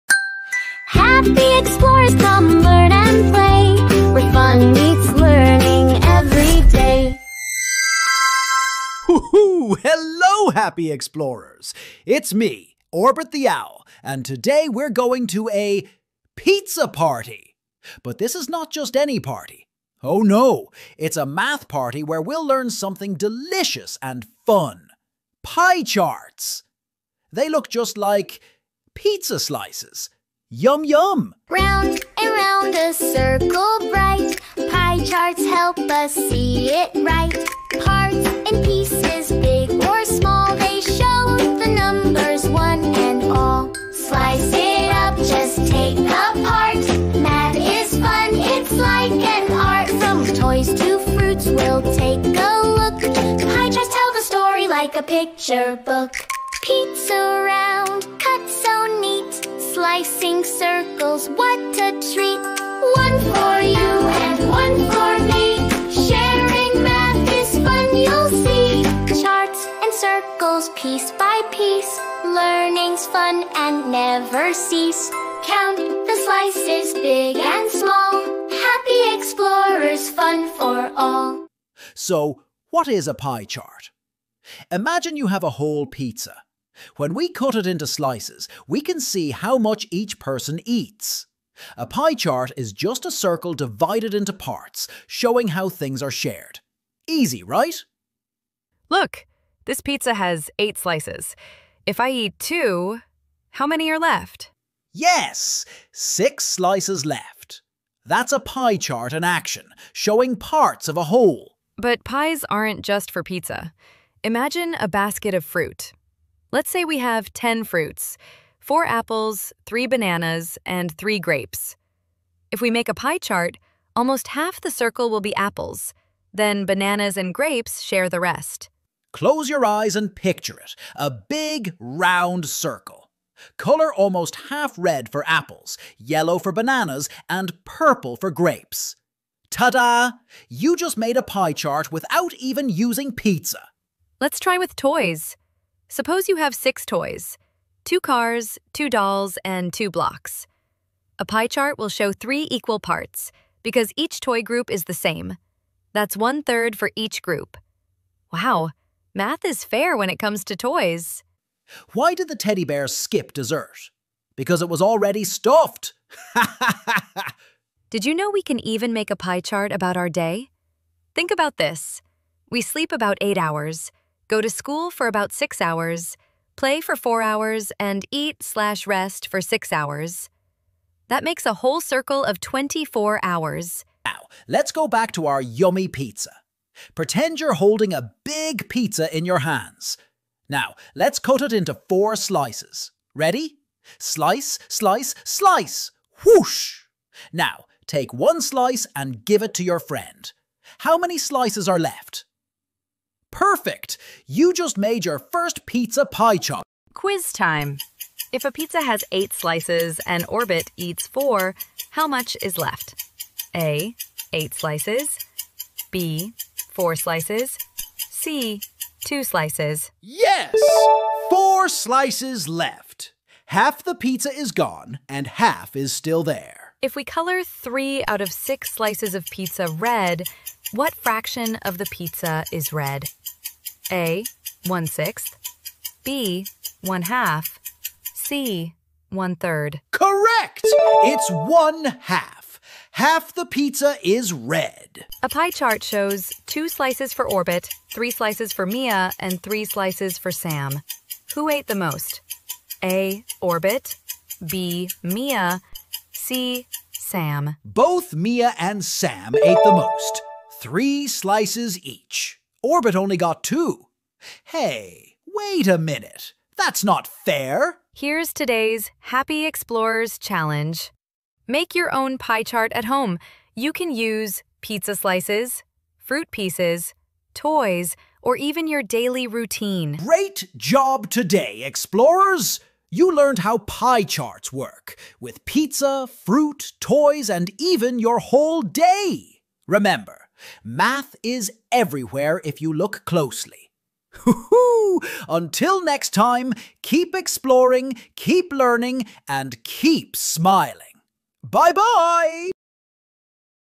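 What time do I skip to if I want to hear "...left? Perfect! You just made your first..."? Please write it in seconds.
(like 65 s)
201 s.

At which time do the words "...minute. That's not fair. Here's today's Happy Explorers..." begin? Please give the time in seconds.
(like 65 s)
265 s.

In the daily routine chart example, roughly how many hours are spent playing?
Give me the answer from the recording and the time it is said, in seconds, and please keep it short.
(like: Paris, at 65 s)
4, at 176 s.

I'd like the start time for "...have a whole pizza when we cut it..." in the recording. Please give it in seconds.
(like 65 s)
85 s.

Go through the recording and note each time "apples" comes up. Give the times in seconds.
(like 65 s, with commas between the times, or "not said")
118 s, 125 s, 135 s.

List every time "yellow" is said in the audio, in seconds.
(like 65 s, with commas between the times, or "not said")
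135 s.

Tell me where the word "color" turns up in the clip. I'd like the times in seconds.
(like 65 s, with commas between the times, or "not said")
133 s, 227 s.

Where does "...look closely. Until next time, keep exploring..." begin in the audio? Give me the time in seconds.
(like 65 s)
292 s.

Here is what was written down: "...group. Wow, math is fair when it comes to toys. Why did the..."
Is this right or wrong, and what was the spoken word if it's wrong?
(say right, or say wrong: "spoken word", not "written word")
right.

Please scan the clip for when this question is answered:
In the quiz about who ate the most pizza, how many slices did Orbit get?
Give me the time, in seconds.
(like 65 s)
246 s.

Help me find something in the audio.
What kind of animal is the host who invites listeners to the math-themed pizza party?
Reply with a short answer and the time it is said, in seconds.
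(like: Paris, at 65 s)
Owl, at 12 s.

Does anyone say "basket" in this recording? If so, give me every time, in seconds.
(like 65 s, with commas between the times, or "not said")
114 s.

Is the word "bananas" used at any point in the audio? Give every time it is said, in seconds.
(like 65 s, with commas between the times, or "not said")
119 s, 126 s, 136 s.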